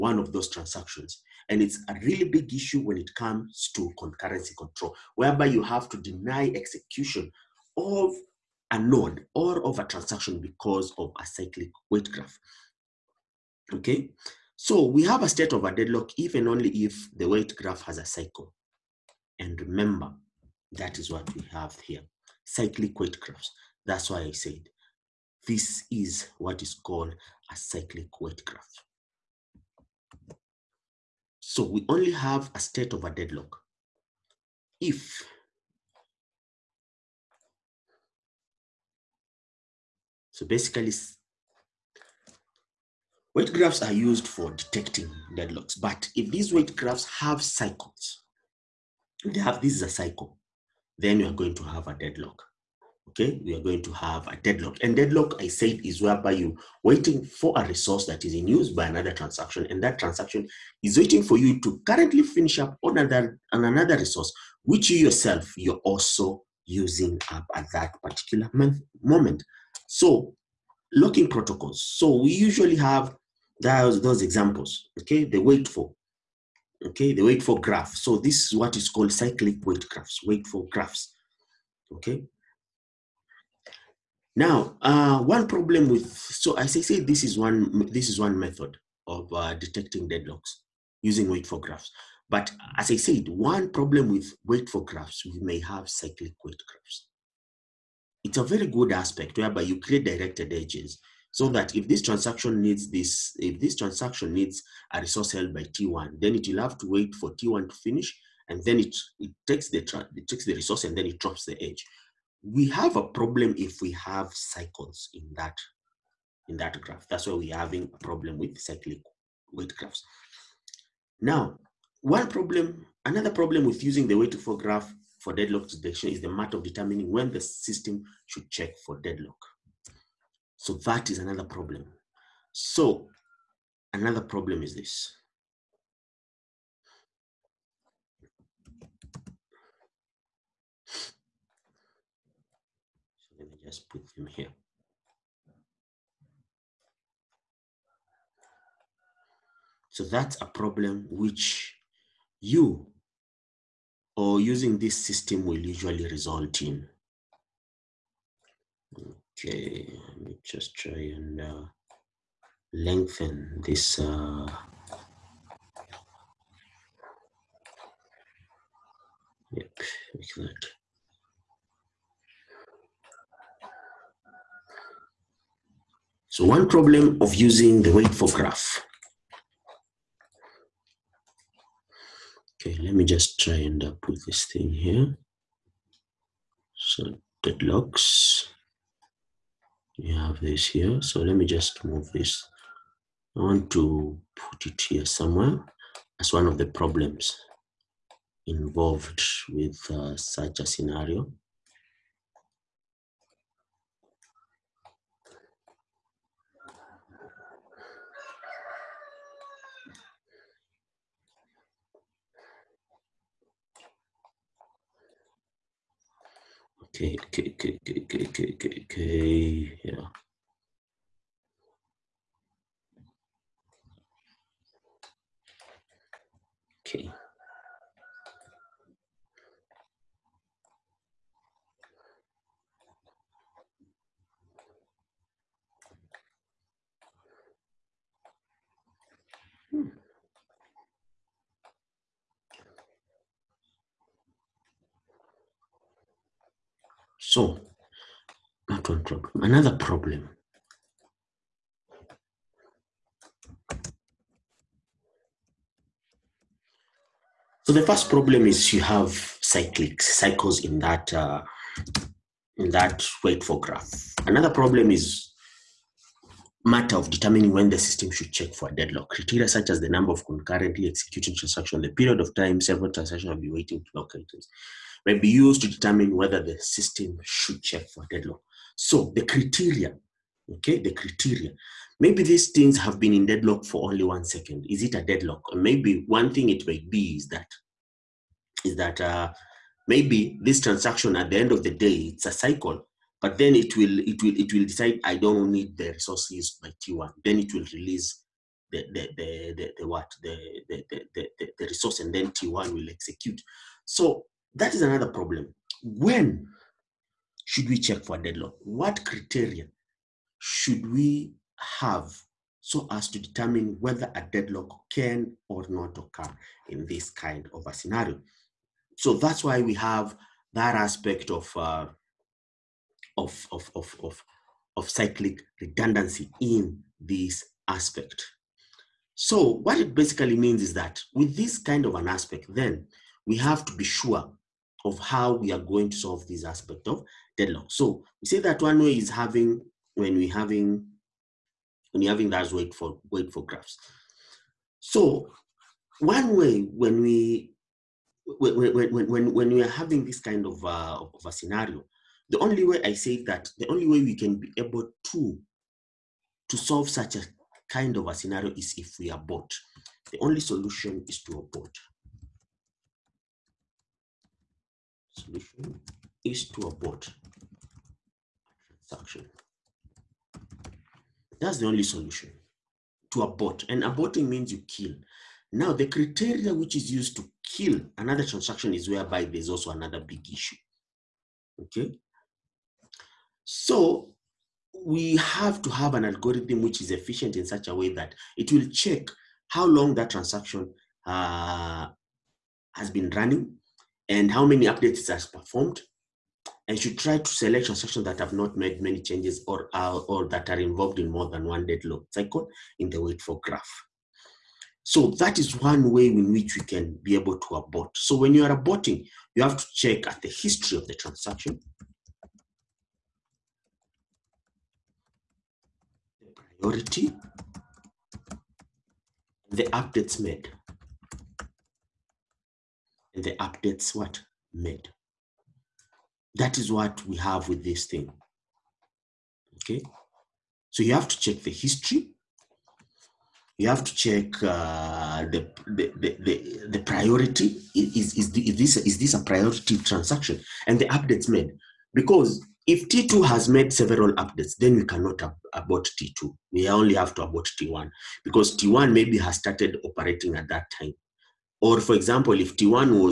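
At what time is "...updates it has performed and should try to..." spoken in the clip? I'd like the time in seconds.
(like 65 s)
394 s.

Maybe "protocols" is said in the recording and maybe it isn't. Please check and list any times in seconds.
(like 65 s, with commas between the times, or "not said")
71 s.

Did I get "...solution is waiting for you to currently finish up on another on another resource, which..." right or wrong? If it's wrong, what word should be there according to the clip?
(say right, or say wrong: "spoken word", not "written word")
wrong: "transaction", not "solution".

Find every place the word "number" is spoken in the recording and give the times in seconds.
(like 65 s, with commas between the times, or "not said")
269 s.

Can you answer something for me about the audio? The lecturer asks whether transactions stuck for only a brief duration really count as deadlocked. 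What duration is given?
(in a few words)
One second.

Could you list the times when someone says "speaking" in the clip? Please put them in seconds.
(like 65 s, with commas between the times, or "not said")
not said.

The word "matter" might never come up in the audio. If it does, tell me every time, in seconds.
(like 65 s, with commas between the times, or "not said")
126 s, 266 s.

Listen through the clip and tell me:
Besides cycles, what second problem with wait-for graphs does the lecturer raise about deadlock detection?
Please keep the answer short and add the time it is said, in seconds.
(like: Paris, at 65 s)
When the system should check for deadlock, at 127 s.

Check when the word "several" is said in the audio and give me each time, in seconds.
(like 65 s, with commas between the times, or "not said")
272 s, 443 s.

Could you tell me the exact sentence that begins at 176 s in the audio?
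So one problem of using the wait for graph.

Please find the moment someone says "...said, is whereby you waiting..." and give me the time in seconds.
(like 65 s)
55 s.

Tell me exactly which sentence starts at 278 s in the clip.
So the criteria, okay, the criteria.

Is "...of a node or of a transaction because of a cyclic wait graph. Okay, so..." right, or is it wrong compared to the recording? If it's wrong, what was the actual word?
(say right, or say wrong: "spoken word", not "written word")
right.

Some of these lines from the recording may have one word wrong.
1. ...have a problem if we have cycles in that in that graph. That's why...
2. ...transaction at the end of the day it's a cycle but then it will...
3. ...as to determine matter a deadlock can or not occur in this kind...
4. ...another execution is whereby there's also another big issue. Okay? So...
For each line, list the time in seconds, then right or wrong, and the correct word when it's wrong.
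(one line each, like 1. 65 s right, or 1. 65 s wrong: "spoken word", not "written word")
1. 112 s right
2. 290 s right
3. 312 s wrong: "whether", not "matter"
4. 377 s wrong: "transaction", not "execution".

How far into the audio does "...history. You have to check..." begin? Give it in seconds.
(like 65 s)
431 s.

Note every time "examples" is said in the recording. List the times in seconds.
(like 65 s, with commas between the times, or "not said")
74 s, 451 s.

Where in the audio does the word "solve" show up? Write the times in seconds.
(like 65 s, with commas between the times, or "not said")
335 s, 356 s.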